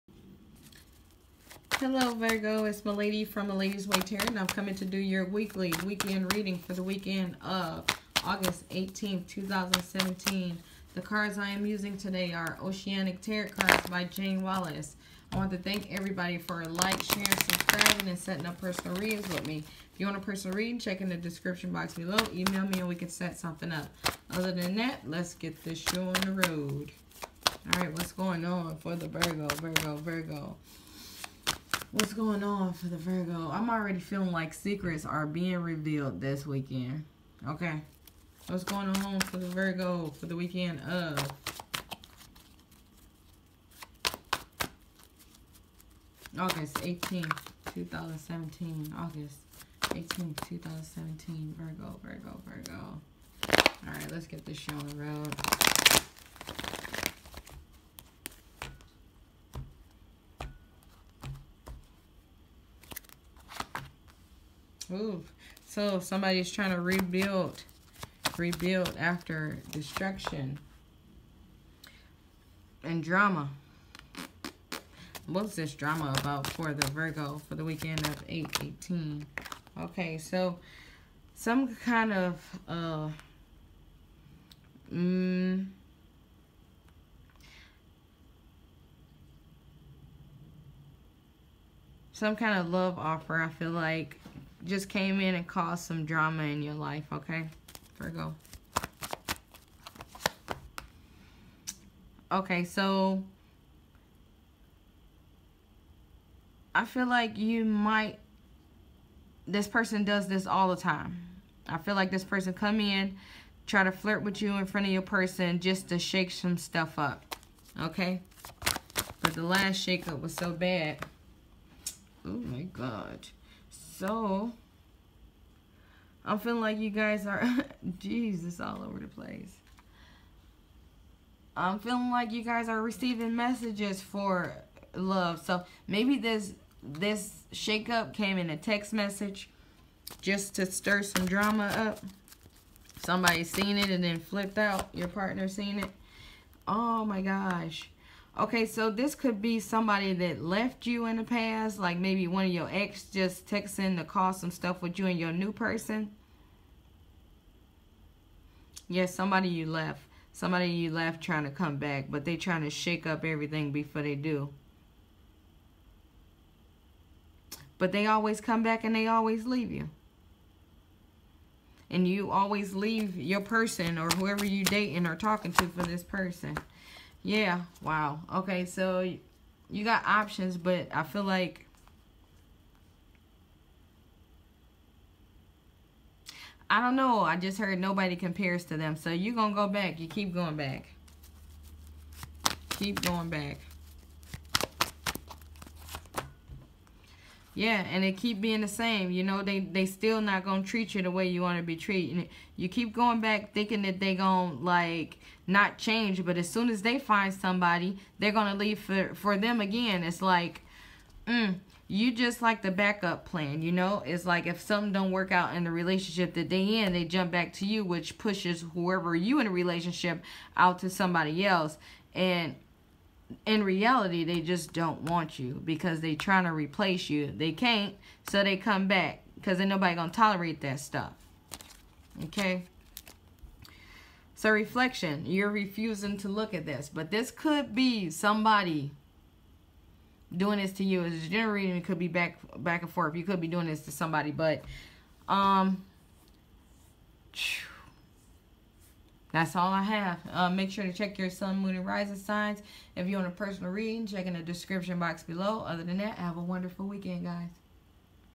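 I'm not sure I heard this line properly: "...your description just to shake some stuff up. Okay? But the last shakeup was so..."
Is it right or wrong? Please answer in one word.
wrong.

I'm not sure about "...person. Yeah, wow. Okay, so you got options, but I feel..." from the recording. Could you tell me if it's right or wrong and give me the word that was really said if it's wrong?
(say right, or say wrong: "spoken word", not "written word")
right.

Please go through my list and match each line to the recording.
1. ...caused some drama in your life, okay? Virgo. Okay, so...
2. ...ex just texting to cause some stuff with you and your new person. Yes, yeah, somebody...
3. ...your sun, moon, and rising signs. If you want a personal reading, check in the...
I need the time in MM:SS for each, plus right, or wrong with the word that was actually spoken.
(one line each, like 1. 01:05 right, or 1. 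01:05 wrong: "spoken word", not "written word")
1. 01:35 right
2. 02:32 right
3. 04:11 right.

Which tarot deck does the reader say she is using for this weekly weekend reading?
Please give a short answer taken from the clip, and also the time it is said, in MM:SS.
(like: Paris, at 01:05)
Oceanic Tarot Cards, at 00:12.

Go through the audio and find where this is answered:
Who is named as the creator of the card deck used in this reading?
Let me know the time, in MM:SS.
00:14.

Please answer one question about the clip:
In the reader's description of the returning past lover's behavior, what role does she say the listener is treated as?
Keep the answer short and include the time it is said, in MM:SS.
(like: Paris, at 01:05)
backup plan, at 03:32.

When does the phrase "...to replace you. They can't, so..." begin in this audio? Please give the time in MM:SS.
03:46.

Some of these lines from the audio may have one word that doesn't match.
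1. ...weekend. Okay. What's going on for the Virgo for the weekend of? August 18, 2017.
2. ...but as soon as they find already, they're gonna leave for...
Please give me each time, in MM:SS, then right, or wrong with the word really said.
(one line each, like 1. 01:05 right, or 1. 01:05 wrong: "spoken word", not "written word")
1. 00:36 right
2. 03:26 wrong: "somebody", not "already".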